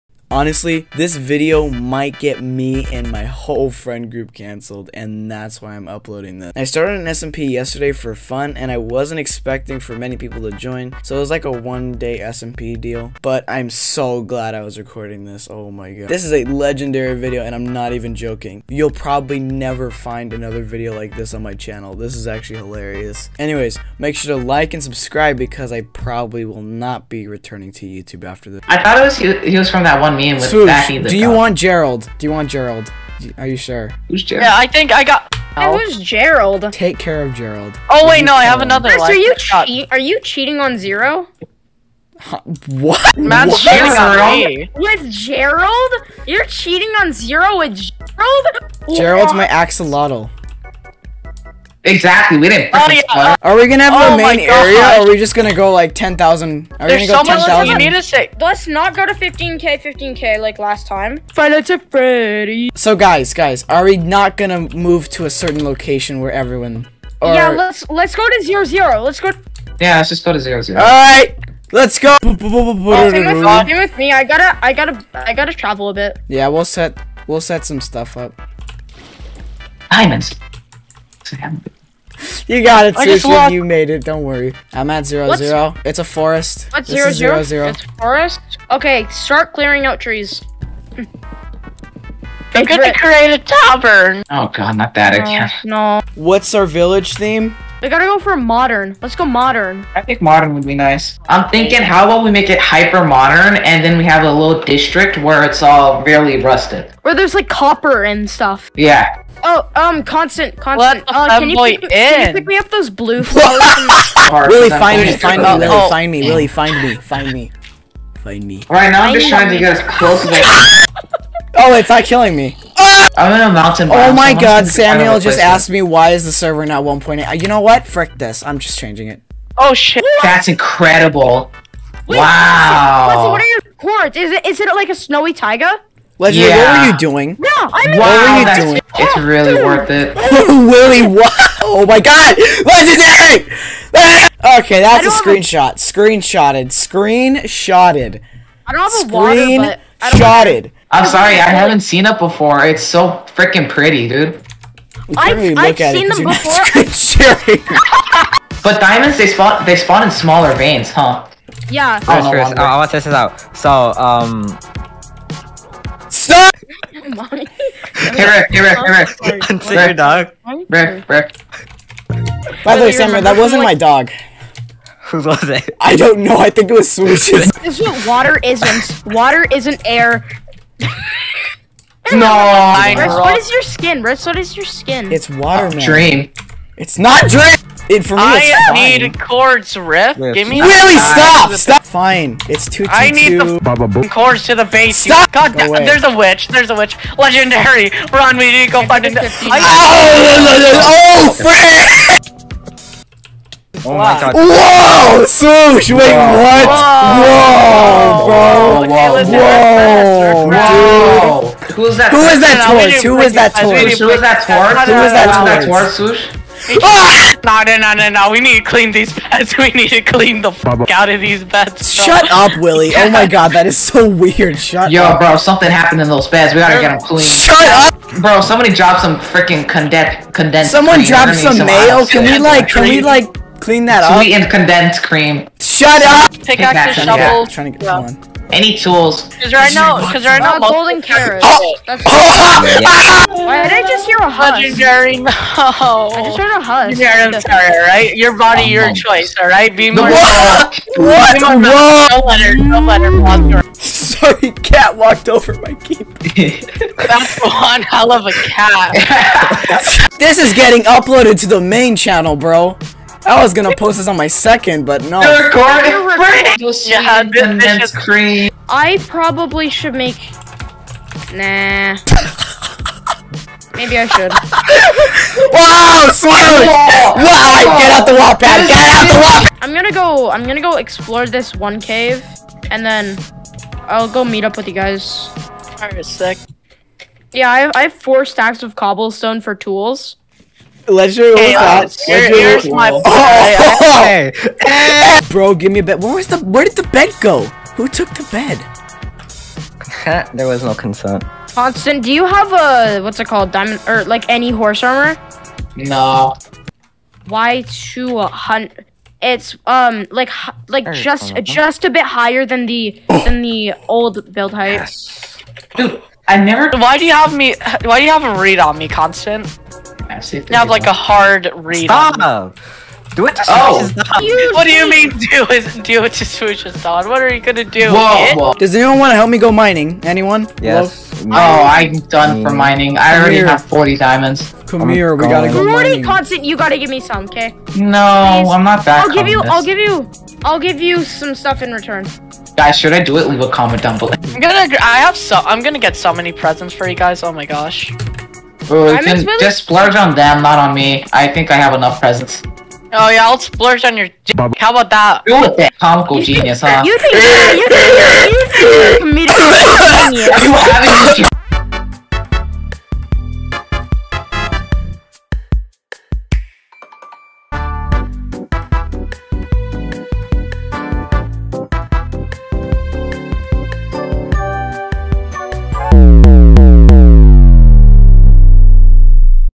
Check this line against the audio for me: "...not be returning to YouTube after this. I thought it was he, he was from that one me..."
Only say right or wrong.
right.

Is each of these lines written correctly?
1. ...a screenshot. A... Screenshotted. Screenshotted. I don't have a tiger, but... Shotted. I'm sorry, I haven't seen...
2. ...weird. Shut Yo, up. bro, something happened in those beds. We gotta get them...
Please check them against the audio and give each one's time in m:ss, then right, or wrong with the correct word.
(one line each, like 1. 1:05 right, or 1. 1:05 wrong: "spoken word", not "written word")
1. 2:25 wrong: "water", not "tiger"
2. 3:44 right.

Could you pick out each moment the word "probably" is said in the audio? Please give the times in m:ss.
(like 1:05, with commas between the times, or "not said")
0:18, 0:25, 4:29.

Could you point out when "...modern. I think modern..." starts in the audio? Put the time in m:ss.
1:39.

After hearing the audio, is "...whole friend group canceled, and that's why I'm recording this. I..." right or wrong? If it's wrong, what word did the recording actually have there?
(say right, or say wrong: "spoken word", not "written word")
wrong: "uploading", not "recording".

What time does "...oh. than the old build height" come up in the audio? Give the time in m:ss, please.
5:13.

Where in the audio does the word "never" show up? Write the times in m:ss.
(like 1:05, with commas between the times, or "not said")
0:19, 5:16.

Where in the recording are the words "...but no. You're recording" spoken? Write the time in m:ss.
4:24.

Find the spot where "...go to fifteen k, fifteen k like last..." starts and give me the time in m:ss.
0:58.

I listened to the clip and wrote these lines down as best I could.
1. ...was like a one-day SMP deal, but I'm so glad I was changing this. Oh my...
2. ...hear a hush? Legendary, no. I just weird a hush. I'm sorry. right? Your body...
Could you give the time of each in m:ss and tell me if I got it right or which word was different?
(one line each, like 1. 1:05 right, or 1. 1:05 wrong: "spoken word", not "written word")
1. 0:11 wrong: "recording", not "changing"
2. 4:04 wrong: "heard", not "weird".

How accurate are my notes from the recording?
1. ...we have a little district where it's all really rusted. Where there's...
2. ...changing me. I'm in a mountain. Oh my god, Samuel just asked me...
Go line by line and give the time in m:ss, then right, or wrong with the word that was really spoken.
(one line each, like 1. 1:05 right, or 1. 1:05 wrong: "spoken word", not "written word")
1. 1:43 right
2. 2:02 wrong: "killing", not "changing".